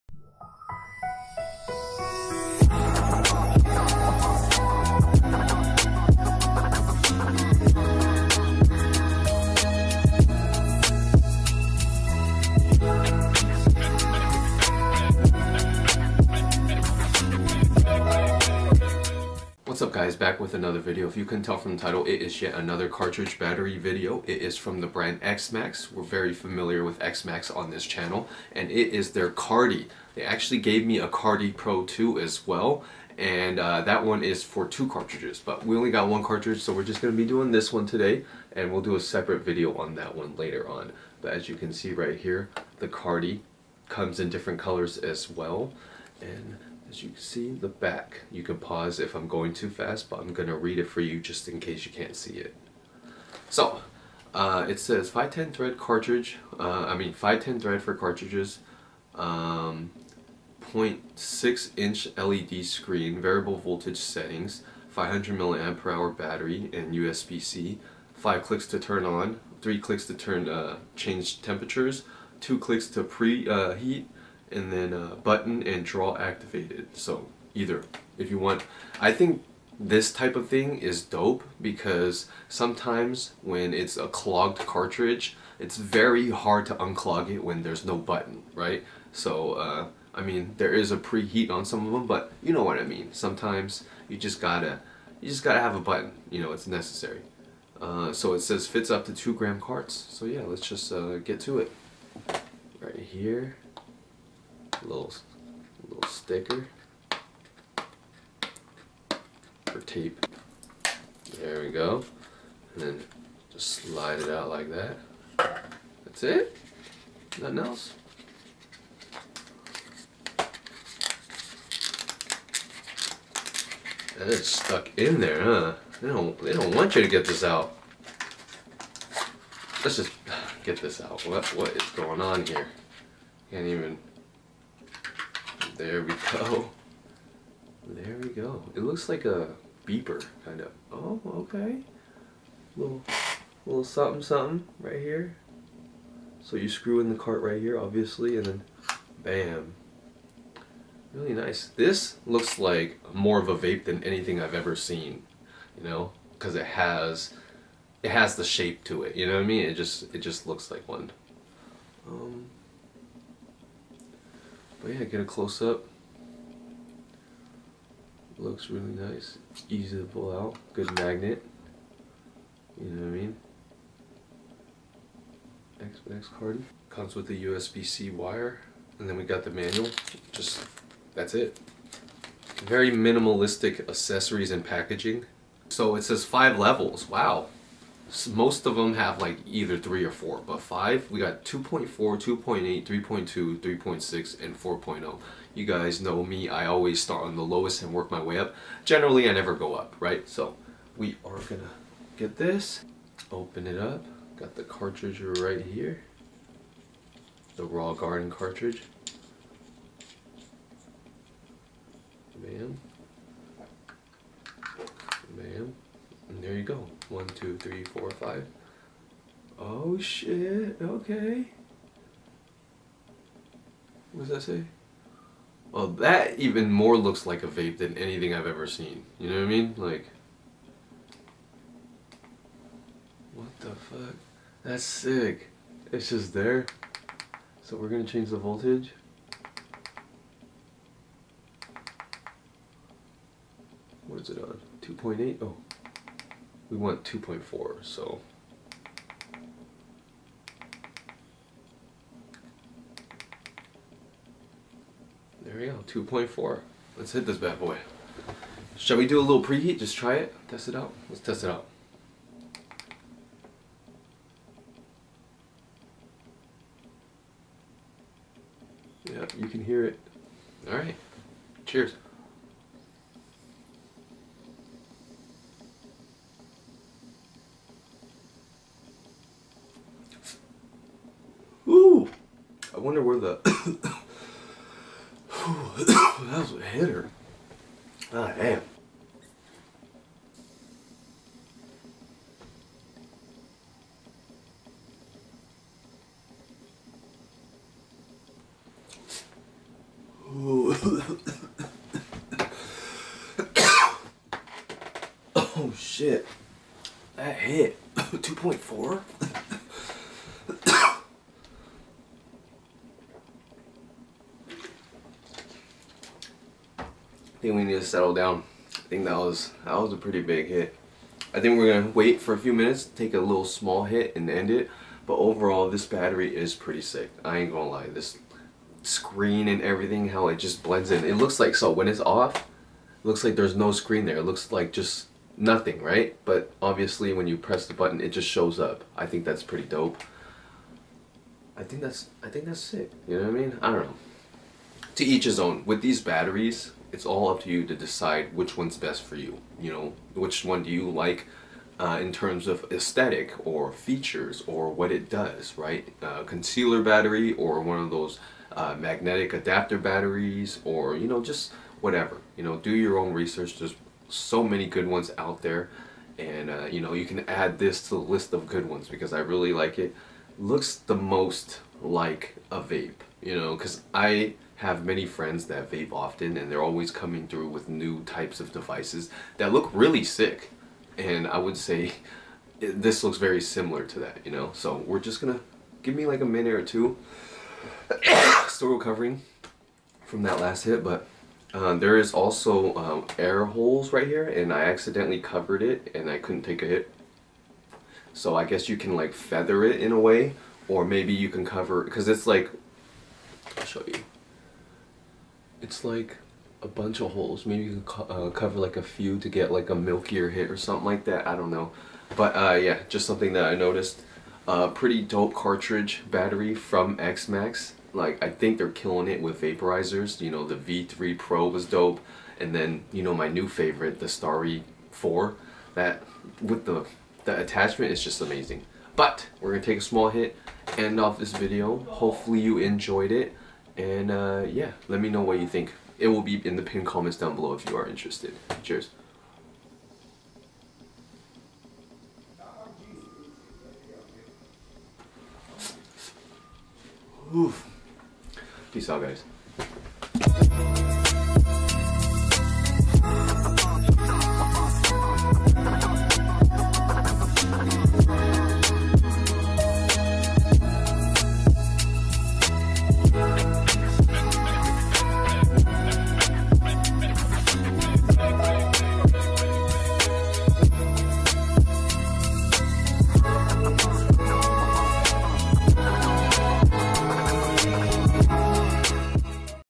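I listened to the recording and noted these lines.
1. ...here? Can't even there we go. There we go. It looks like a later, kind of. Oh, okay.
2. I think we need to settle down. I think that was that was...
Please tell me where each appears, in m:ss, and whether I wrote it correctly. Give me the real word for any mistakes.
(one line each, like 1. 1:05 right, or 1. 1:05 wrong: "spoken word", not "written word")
1. 2:12 wrong: "beeper", not "later"
2. 5:17 right.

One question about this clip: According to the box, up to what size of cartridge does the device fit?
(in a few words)
2 gram.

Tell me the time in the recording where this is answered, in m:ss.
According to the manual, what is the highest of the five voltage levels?
3:14.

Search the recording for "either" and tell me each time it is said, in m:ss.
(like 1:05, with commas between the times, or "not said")
1:17, 3:09.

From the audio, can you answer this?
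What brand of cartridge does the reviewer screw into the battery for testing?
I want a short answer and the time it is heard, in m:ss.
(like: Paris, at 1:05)
Raw Garden, at 3:27.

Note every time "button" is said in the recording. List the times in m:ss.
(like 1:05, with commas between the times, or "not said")
1:15, 1:27, 1:35, 5:37.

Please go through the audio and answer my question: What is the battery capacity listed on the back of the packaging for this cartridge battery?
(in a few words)
500 milliamp per hour.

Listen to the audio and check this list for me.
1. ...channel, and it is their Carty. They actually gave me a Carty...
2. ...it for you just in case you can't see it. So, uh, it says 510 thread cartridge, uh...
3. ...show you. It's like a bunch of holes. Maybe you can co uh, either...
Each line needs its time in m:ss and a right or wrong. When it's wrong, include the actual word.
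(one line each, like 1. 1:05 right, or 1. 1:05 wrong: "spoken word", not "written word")
1. 0:27 right
2. 0:50 right
3. 6:43 wrong: "cover", not "either".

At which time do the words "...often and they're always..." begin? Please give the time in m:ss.
6:15.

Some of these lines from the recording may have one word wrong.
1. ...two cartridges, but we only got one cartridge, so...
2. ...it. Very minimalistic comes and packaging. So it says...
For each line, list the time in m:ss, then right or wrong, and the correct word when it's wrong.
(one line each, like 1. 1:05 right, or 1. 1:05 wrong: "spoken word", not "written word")
1. 0:34 right
2. 3:01 wrong: "accessories", not "comes".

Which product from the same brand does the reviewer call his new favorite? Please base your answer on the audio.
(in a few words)
Starry 4.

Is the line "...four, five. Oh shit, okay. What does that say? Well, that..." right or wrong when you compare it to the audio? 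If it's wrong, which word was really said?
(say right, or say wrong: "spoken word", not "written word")
right.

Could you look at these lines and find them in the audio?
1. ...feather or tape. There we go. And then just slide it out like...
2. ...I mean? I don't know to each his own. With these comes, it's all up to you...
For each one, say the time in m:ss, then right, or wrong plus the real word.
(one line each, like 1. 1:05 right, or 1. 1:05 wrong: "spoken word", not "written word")
1. 1:46 wrong: "sticker", not "feather"
2. 5:43 wrong: "batteries", not "comes".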